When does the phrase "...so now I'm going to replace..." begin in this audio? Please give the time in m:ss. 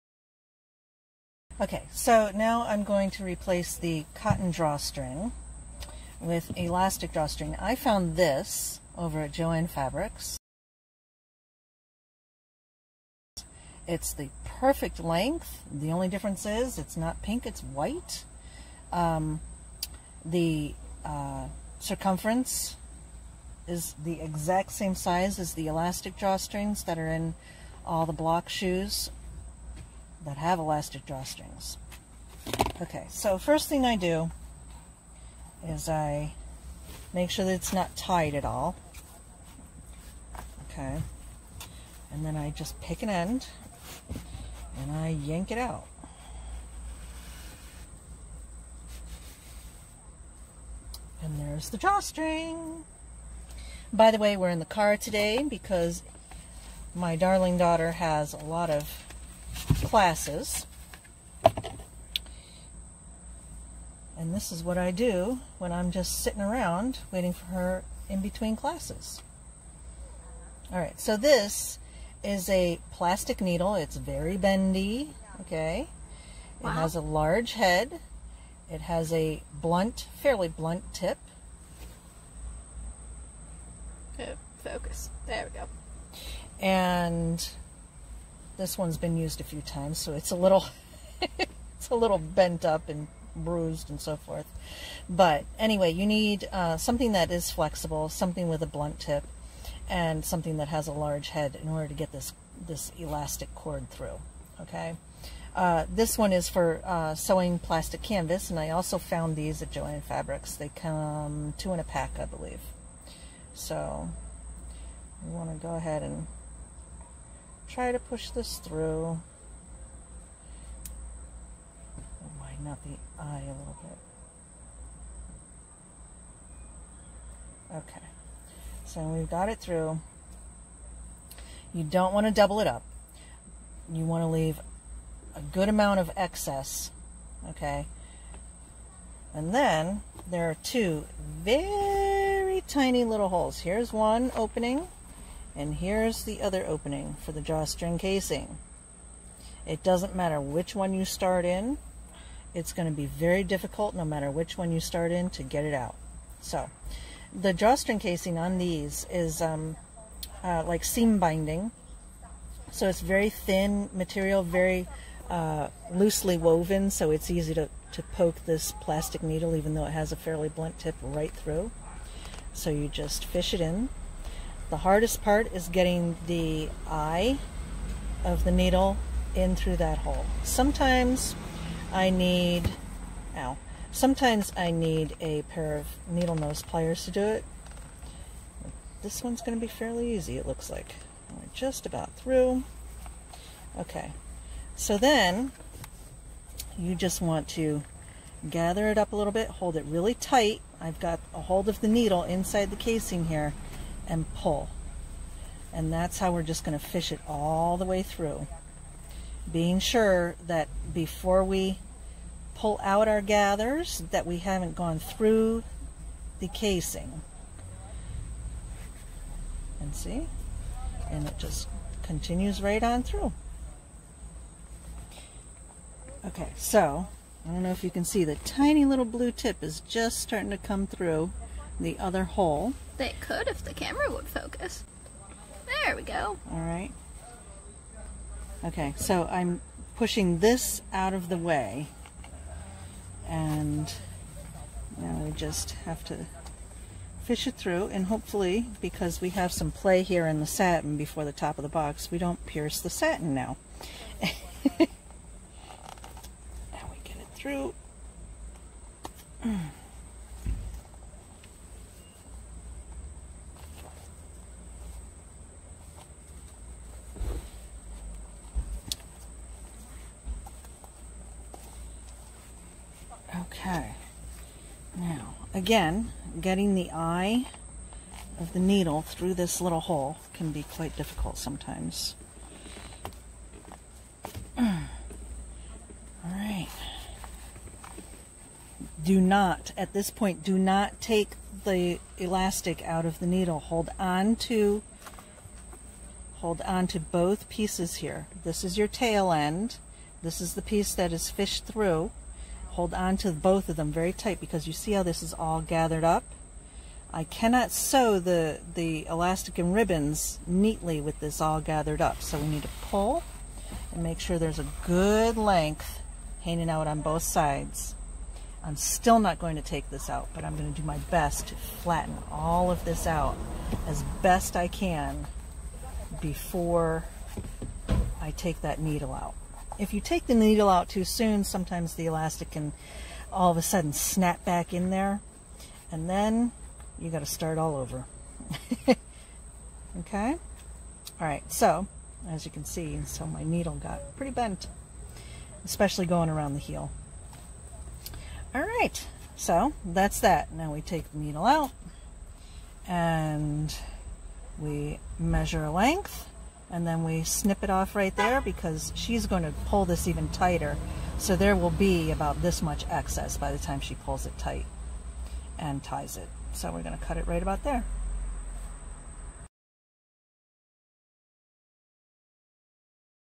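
0:01.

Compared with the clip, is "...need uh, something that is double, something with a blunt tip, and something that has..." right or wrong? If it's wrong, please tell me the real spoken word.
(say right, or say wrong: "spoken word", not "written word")
wrong: "flexible", not "double".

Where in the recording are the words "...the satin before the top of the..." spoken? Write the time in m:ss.
4:10.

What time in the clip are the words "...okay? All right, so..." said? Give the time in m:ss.
5:40.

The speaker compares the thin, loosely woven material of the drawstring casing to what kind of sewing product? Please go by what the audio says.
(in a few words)
Seam binding.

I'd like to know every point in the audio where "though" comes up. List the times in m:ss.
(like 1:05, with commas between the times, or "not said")
2:49.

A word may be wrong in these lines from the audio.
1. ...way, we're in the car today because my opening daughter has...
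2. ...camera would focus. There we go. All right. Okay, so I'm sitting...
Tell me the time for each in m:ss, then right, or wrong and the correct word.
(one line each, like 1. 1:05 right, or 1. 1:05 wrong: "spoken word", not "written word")
1. 0:54 wrong: "darling", not "opening"
2. 3:53 wrong: "pushing", not "sitting".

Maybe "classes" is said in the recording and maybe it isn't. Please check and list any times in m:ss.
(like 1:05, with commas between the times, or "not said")
0:59, 1:08.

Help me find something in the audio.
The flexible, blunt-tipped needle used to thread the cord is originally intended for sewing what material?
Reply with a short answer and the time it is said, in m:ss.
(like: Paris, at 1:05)
Plastic canvas, at 1:47.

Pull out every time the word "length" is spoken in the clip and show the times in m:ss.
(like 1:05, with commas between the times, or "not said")
0:14, 5:15, 5:55.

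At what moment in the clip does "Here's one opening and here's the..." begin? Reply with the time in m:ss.
2:23.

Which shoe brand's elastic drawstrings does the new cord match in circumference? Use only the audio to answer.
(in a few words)
Bloch.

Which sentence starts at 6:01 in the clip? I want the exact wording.
So there will be about this much excess by the time she pulls it tight and ties it.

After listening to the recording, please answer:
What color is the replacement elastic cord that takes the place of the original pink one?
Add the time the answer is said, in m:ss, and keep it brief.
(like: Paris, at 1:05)
White, at 0:17.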